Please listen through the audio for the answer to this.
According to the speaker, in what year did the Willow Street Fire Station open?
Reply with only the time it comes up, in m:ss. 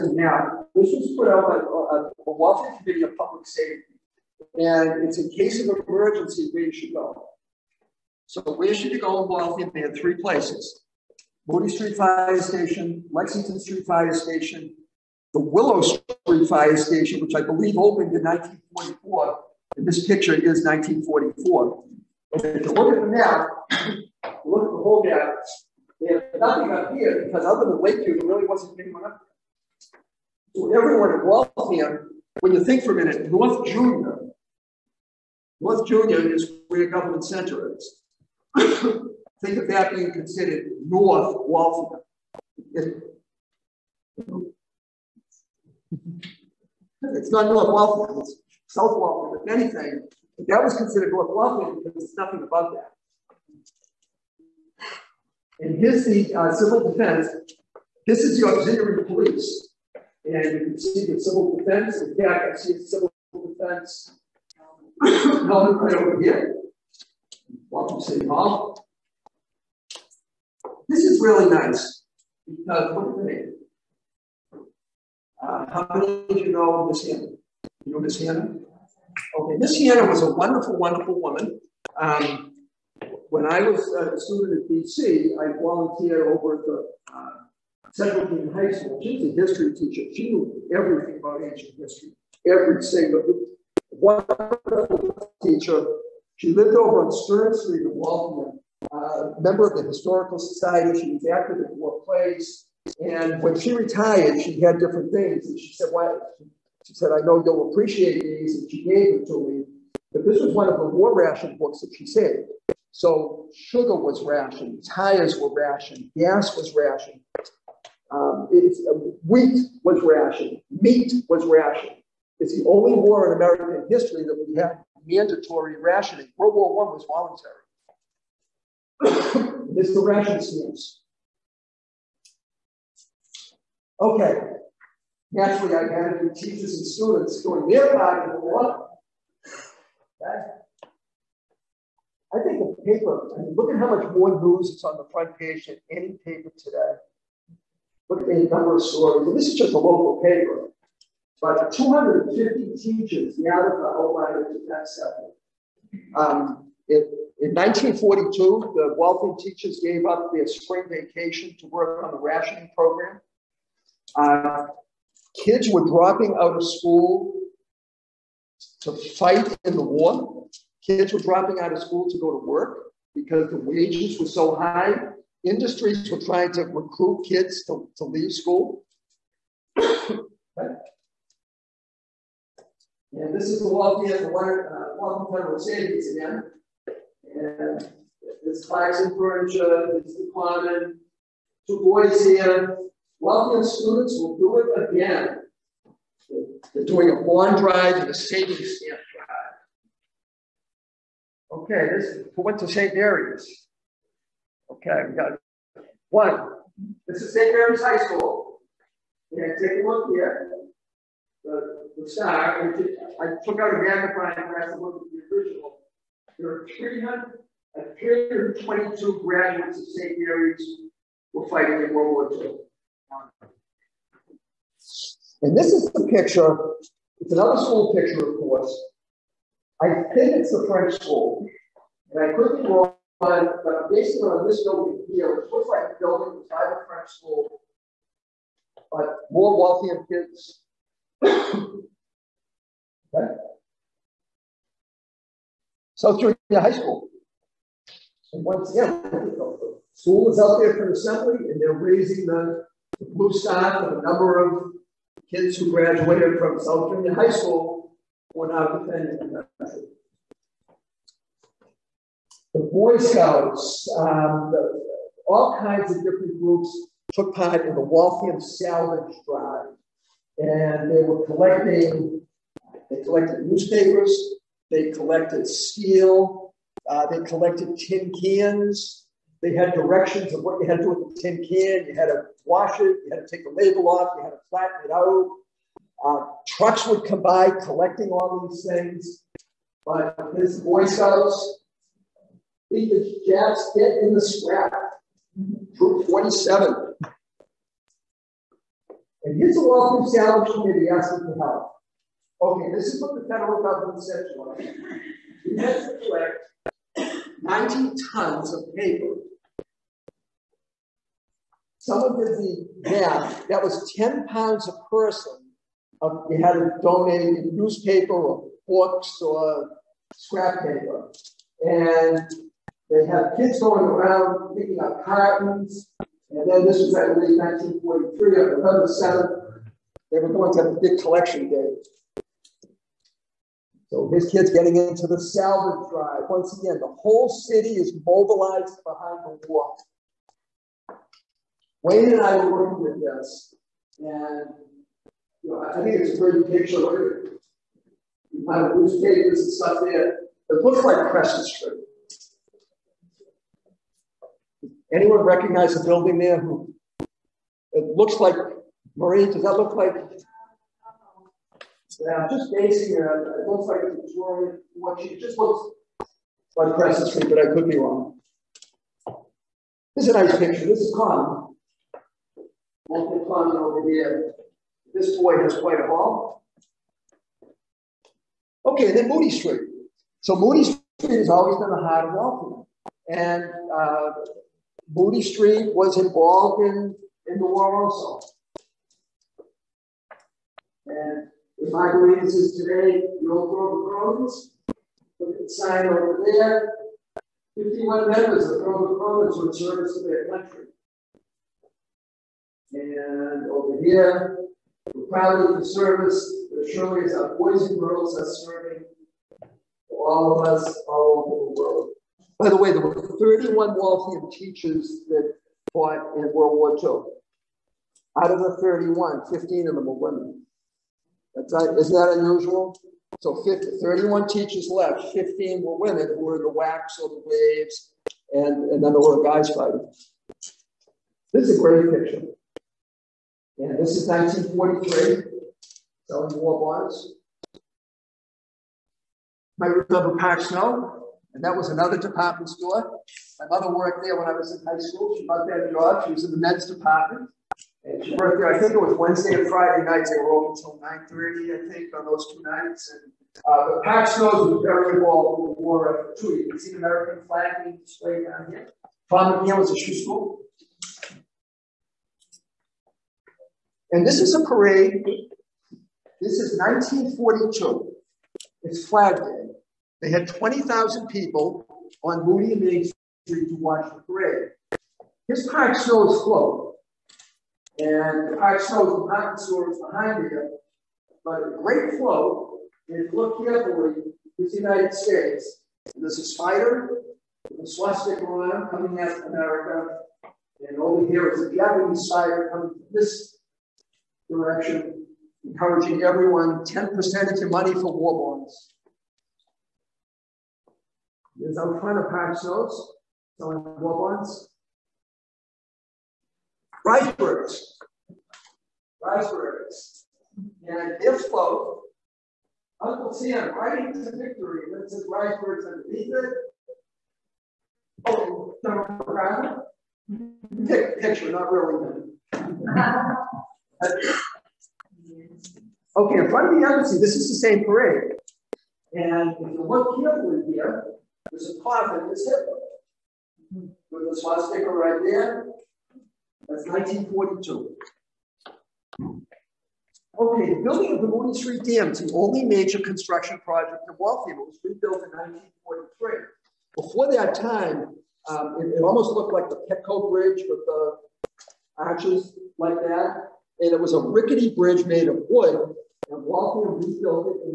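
0:17.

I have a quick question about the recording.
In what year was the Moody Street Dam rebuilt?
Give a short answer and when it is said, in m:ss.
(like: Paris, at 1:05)
1943, at 9:04.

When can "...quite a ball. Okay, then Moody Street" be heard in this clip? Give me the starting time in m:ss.
6:15.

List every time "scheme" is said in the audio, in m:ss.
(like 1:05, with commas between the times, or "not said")
not said.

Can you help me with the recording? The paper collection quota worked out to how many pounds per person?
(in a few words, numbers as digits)
10 pounds.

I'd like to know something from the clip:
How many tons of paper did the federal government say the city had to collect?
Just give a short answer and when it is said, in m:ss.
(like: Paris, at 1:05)
90 tons, at 5:07.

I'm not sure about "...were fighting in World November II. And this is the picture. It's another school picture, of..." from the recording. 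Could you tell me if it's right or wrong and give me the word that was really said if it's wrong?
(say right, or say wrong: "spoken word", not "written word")
wrong: "War", not "November".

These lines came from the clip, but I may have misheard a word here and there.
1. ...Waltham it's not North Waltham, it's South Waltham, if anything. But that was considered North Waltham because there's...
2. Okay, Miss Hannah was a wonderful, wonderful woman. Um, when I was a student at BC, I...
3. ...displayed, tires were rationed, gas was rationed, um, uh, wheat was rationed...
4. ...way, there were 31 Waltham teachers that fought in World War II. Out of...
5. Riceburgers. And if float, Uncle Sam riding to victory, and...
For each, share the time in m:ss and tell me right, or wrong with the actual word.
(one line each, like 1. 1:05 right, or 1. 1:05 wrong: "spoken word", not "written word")
1. 0:41 right
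2. 1:19 right
3. 1:54 wrong: "rationed", not "displayed"
4. 6:52 right
5. 8:29 right.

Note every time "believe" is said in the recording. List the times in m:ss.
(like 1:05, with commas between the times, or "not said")
0:17, 6:31.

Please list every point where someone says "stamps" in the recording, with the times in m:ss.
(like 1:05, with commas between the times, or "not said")
2:10, 3:18.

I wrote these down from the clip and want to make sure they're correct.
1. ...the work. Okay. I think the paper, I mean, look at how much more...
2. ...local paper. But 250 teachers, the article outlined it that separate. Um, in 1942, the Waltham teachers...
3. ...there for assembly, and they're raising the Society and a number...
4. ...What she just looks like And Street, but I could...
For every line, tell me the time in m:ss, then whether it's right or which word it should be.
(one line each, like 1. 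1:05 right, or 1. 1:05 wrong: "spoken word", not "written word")
1. 2:18 right
2. 2:29 right
3. 4:10 wrong: "Mustafa", not "Society"
4. 6:04 wrong: "Crescent", not "And".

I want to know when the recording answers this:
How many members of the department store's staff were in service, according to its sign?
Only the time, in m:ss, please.
6:37.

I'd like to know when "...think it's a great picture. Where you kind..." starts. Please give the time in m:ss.
5:45.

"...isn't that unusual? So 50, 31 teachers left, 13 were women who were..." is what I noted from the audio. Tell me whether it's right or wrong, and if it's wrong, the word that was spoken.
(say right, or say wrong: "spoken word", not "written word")
wrong: "15", not "13".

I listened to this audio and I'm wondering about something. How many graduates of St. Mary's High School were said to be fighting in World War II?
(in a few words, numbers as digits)
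322.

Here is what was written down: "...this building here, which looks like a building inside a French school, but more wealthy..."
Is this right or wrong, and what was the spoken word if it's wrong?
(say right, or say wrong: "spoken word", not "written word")
right.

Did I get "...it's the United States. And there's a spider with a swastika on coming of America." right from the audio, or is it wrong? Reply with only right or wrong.
right.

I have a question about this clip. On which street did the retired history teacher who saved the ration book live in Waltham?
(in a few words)
Stern Street.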